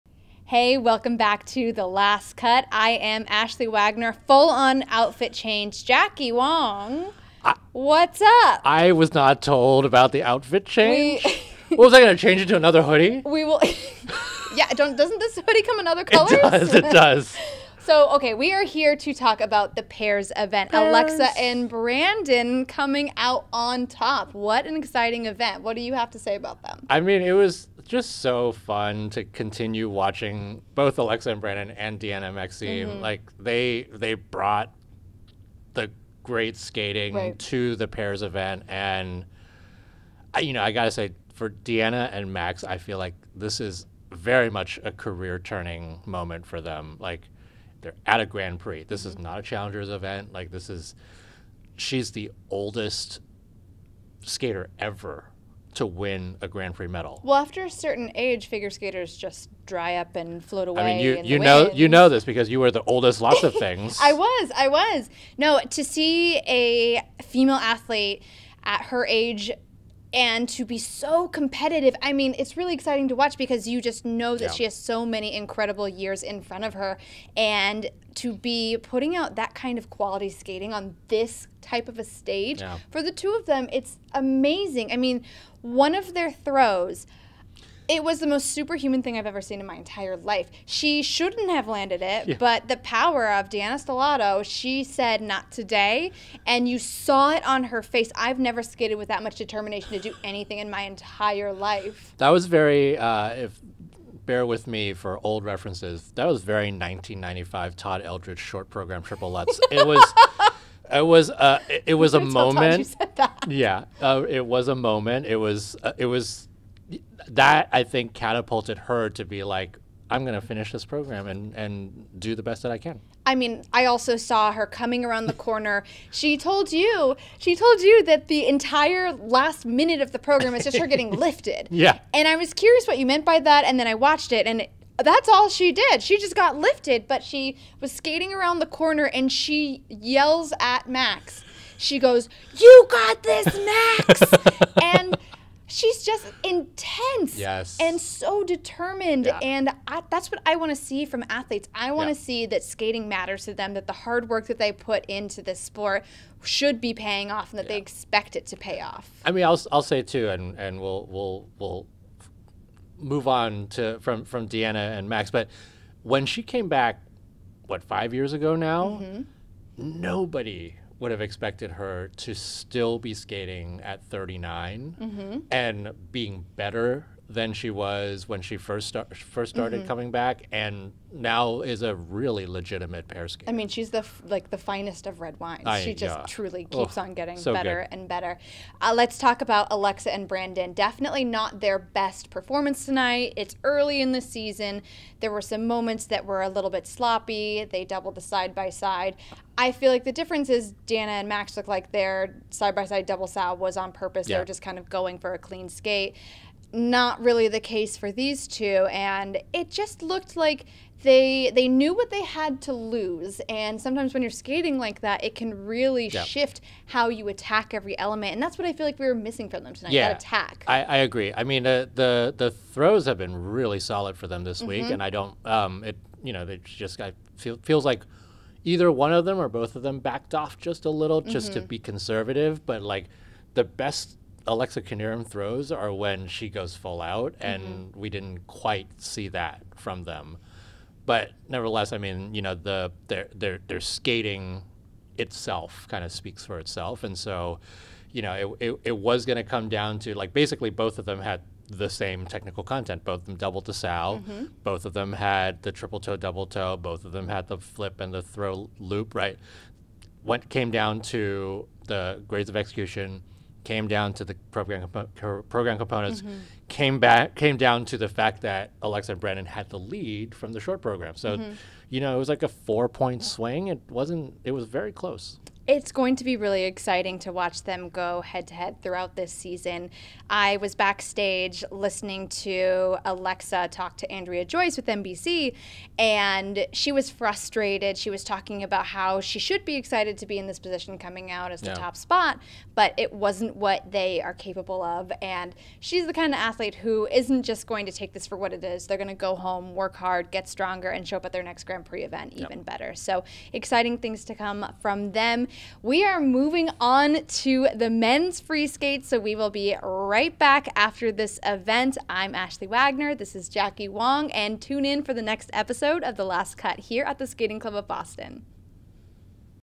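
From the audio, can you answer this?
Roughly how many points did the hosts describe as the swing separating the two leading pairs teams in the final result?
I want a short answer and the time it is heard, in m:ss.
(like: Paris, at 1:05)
4, at 4:32.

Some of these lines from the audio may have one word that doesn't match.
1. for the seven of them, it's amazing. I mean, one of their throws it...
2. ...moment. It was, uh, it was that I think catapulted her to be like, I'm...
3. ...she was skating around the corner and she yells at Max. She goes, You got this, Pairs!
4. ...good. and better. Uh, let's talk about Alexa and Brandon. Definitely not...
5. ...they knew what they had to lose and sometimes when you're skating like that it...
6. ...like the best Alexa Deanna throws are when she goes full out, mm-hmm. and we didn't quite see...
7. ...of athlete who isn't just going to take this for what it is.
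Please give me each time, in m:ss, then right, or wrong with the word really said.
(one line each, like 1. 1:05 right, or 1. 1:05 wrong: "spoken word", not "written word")
1. 1:22 wrong: "two", not "seven"
2. 1:54 right
3. 2:17 wrong: "Max", not "Pairs"
4. 3:07 right
5. 3:31 right
6. 3:52 wrong: "Knierim", not "Deanna"
7. 4:56 right.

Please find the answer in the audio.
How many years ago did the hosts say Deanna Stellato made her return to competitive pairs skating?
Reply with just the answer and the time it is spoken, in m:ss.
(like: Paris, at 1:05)
5, at 2:47.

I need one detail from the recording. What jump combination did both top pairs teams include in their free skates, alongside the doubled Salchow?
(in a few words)
triple toe, double toe.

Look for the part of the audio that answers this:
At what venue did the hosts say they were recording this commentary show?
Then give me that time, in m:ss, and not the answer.
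5:17.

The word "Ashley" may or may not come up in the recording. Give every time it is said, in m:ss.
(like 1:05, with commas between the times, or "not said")
0:03, 5:12.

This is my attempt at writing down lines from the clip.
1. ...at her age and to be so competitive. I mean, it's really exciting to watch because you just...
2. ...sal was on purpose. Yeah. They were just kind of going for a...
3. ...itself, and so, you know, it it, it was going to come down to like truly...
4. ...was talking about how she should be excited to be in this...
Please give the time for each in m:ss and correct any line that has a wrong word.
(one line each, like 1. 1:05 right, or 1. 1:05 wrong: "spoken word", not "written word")
1. 1:08 right
2. 3:23 right
3. 4:06 wrong: "basically", not "truly"
4. 4:48 right.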